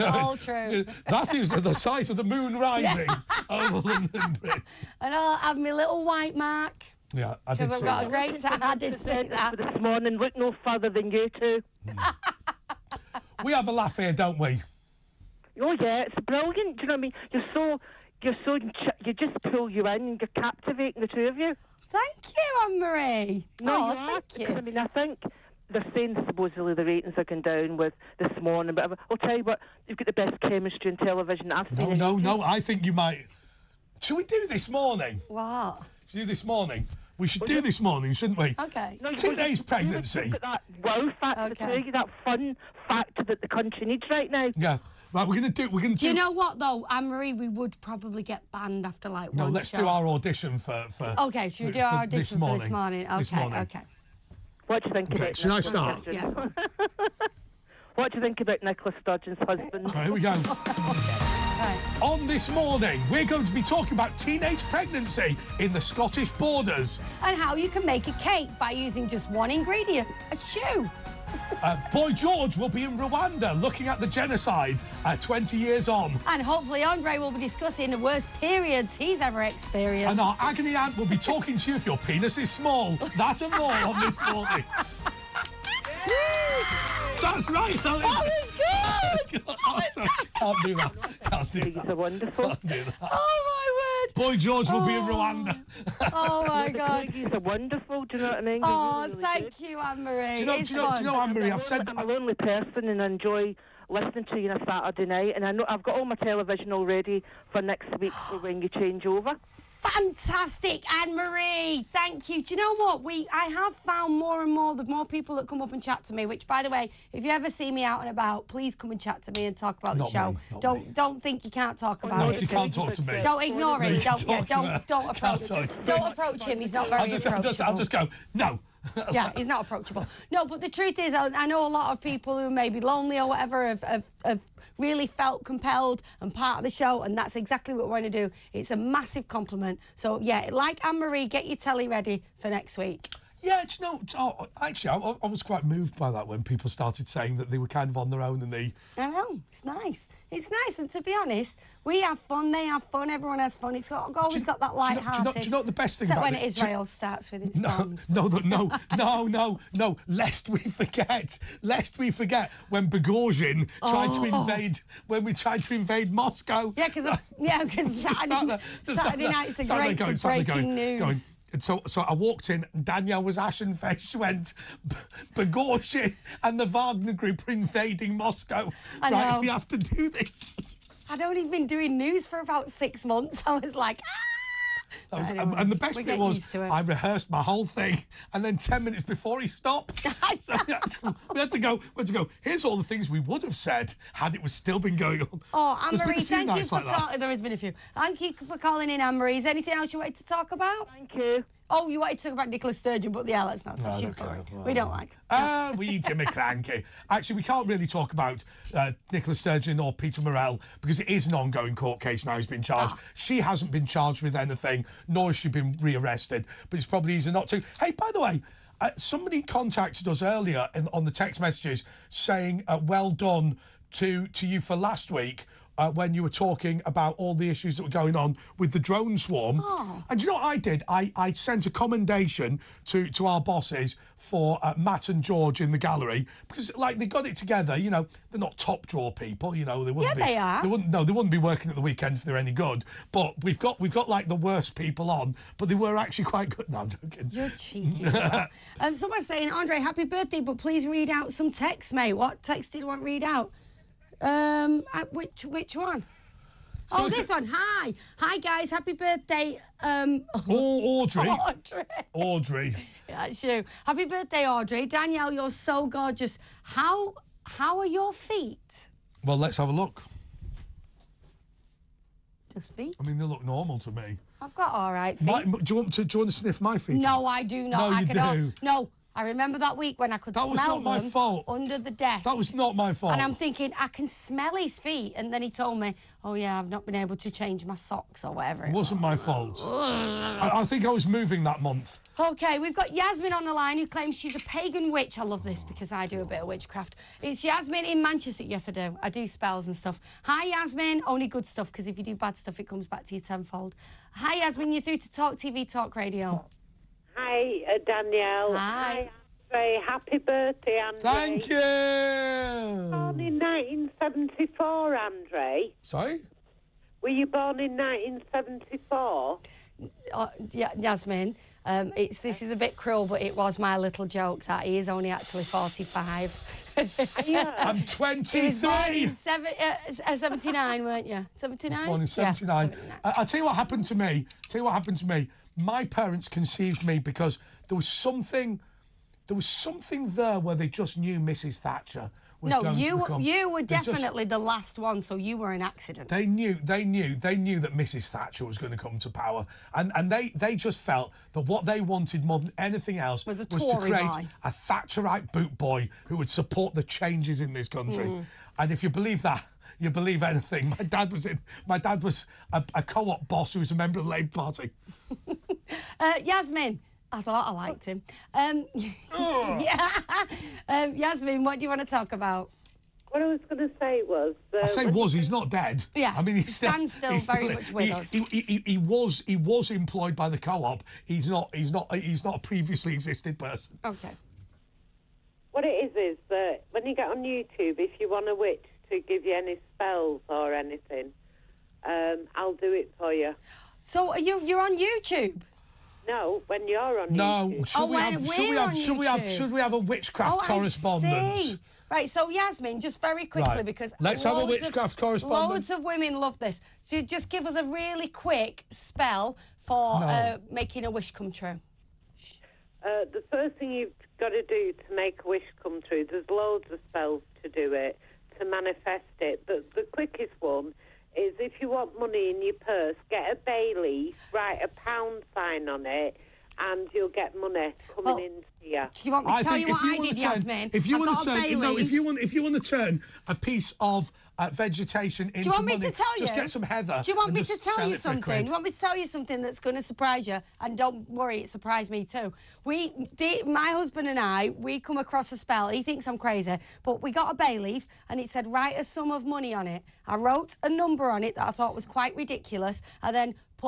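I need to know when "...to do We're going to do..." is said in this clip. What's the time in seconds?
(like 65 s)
45 s.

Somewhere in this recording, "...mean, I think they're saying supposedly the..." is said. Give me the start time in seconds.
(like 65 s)
24 s.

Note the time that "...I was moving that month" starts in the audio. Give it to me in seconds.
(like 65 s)
290 s.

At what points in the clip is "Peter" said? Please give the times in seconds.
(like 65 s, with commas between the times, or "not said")
209 s.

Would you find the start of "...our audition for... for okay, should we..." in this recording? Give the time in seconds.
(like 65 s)
49 s.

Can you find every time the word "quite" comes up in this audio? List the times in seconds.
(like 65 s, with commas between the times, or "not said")
145 s, 246 s, 451 s.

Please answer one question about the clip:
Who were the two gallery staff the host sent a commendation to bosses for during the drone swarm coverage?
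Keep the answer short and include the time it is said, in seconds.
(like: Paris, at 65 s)
Matt and George, at 234 s.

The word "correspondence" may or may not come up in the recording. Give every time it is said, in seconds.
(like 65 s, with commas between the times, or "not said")
400 s, 404 s.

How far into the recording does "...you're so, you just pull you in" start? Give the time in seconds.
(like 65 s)
18 s.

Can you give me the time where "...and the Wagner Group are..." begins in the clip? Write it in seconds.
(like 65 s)
176 s.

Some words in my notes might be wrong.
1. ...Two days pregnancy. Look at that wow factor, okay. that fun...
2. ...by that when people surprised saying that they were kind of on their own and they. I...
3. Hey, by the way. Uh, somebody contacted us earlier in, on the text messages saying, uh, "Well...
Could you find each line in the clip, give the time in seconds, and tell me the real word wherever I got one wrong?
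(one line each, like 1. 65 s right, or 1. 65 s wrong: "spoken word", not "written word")
1. 39 s right
2. 145 s wrong: "started", not "surprised"
3. 217 s right.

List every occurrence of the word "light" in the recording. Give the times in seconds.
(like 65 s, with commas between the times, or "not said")
154 s.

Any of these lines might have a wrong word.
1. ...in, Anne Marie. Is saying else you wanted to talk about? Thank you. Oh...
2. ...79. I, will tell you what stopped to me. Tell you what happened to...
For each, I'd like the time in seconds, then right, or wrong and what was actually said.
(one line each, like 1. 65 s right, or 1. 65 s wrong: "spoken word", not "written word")
1. 198 s wrong: "anything", not "saying"
2. 332 s wrong: "happened", not "stopped".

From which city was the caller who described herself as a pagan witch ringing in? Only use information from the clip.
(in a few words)
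Manchester.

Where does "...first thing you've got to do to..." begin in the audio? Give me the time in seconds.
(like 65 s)
413 s.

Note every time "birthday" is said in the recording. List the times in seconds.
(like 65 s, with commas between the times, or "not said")
250 s, 258 s, 264 s, 310 s.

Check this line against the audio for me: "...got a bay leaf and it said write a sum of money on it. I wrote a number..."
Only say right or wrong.
right.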